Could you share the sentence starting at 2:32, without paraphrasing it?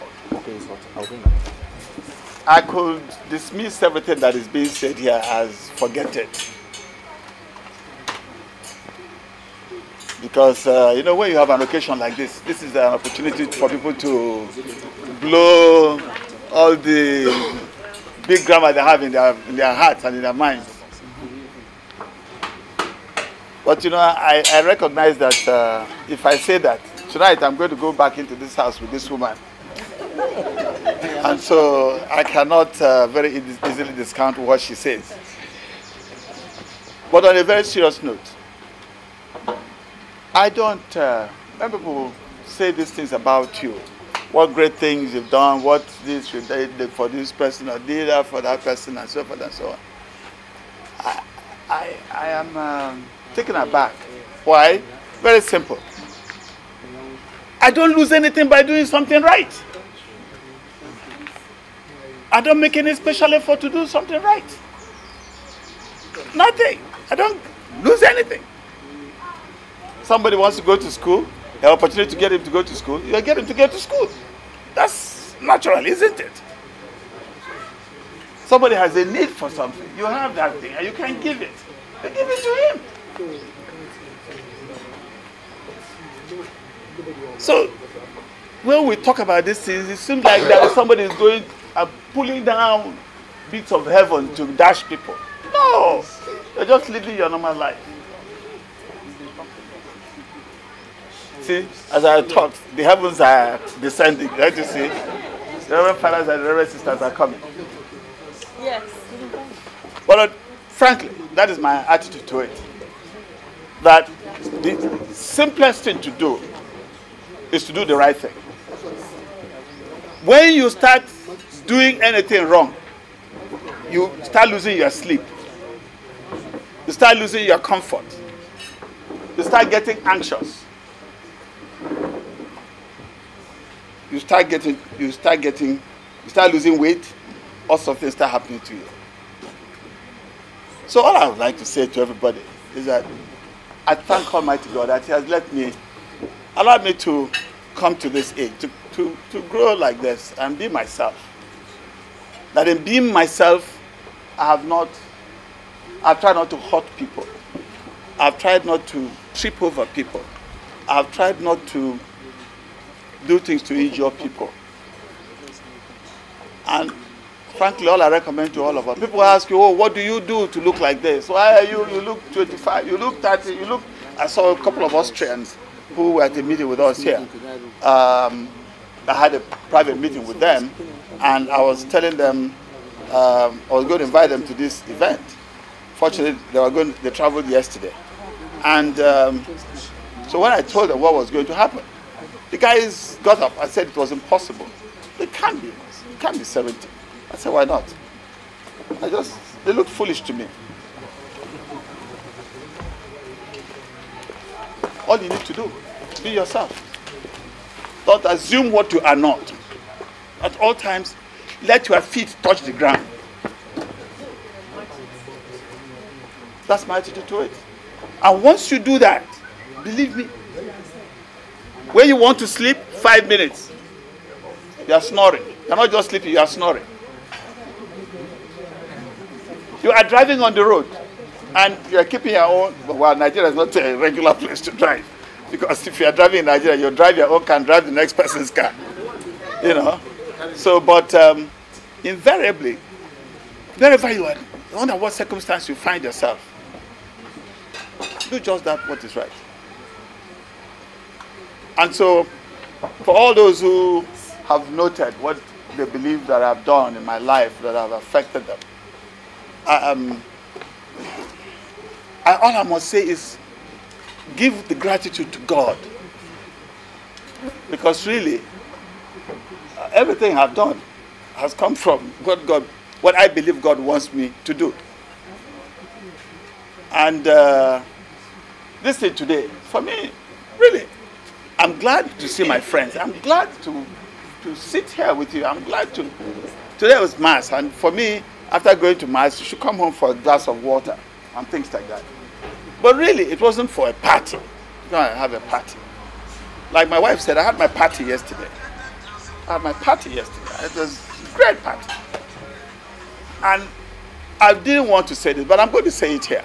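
That in being myself, I have not, I've tried not to hurt people.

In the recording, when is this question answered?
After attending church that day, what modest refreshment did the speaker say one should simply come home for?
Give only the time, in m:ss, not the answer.
4:50.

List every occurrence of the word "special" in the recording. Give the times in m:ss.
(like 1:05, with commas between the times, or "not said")
1:02.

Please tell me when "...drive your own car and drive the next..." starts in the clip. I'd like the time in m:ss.
3:56.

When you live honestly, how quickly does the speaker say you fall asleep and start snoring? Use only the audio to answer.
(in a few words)
5 minutes.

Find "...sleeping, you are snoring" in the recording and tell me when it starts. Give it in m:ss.
3:46.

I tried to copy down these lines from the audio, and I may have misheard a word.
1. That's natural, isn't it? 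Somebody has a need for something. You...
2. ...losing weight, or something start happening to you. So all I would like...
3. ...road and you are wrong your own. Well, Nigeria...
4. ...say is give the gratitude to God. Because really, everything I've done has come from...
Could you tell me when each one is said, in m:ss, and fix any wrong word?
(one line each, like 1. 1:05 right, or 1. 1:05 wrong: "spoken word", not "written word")
1. 1:14 right
2. 2:16 right
3. 3:50 wrong: "keeping", not "wrong"
4. 4:22 right.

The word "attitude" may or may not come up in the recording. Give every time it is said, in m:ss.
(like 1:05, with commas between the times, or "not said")
1:51, 3:36.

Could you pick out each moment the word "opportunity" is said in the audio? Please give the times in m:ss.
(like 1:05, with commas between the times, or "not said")
0:12, 1:11.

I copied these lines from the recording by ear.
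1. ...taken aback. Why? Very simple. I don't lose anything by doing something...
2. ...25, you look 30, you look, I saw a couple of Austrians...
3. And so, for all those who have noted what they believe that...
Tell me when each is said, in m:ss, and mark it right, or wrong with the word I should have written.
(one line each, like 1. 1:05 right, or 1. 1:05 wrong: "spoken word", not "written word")
1. 0:53 right
2. 2:52 right
3. 4:11 right.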